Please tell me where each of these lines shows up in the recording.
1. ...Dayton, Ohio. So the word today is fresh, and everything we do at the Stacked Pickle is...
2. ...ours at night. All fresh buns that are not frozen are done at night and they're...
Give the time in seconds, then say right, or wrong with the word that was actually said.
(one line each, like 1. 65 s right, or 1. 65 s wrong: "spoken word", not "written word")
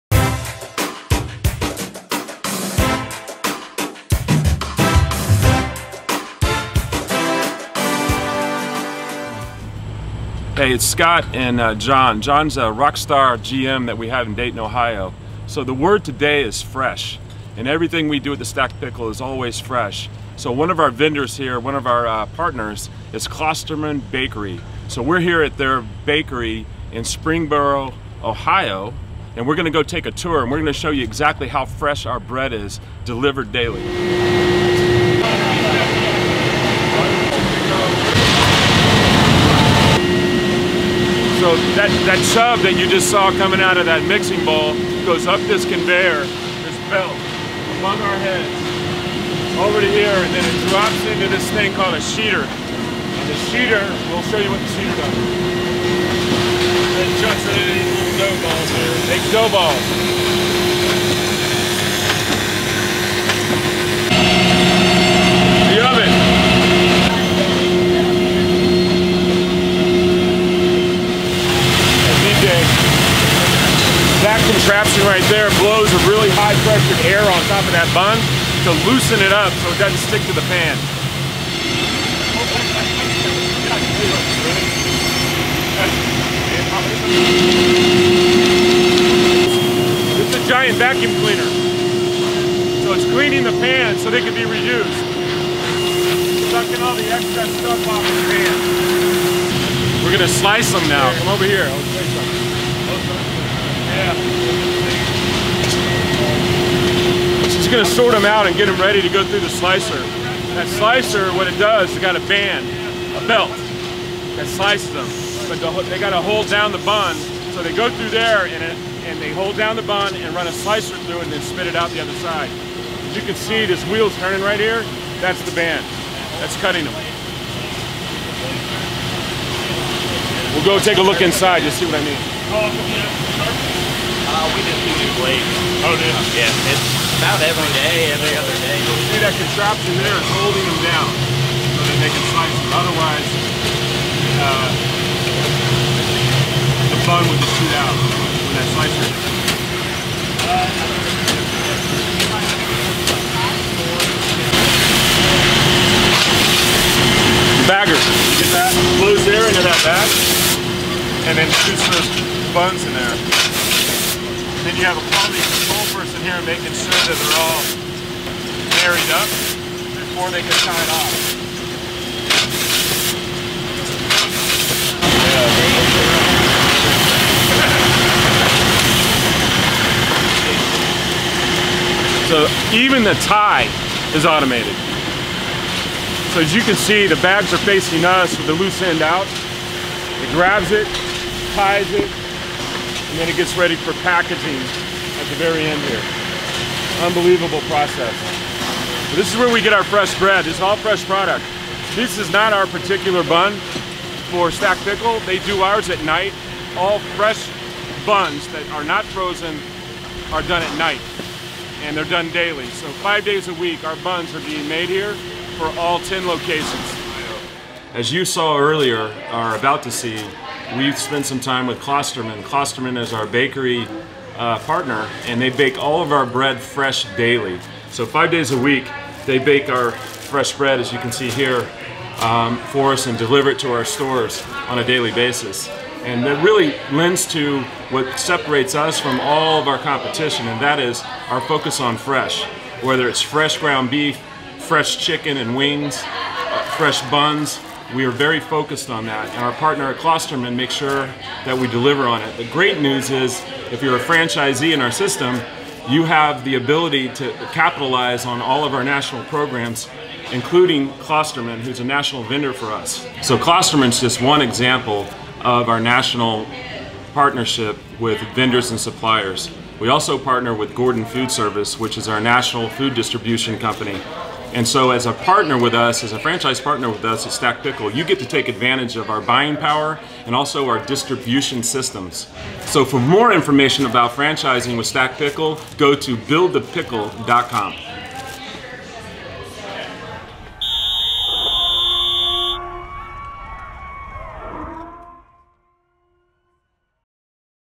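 1. 14 s right
2. 205 s right.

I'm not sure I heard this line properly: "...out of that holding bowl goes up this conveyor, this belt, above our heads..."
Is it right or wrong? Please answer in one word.
wrong.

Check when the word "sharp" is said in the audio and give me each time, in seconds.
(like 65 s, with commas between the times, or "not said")
not said.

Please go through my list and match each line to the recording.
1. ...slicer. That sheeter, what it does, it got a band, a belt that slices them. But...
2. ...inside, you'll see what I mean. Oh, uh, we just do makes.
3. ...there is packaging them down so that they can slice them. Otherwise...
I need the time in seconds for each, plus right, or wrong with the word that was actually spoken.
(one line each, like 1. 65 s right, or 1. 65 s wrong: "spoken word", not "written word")
1. 109 s wrong: "slicer", not "sheeter"
2. 131 s wrong: "blades", not "makes"
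3. 140 s wrong: "holding", not "packaging".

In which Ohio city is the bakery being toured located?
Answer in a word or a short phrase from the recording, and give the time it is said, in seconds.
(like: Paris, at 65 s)
Springboro, at 27 s.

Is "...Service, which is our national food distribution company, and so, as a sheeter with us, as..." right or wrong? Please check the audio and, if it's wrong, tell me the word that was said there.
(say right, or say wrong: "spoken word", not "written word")
wrong: "partner", not "sheeter".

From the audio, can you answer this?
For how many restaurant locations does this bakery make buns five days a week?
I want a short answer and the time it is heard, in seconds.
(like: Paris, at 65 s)
10, at 215 s.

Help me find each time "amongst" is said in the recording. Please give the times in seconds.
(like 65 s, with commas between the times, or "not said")
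not said.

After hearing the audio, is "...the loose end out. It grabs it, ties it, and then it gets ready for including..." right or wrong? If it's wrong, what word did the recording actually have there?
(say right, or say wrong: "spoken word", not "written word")
wrong: "packaging", not "including".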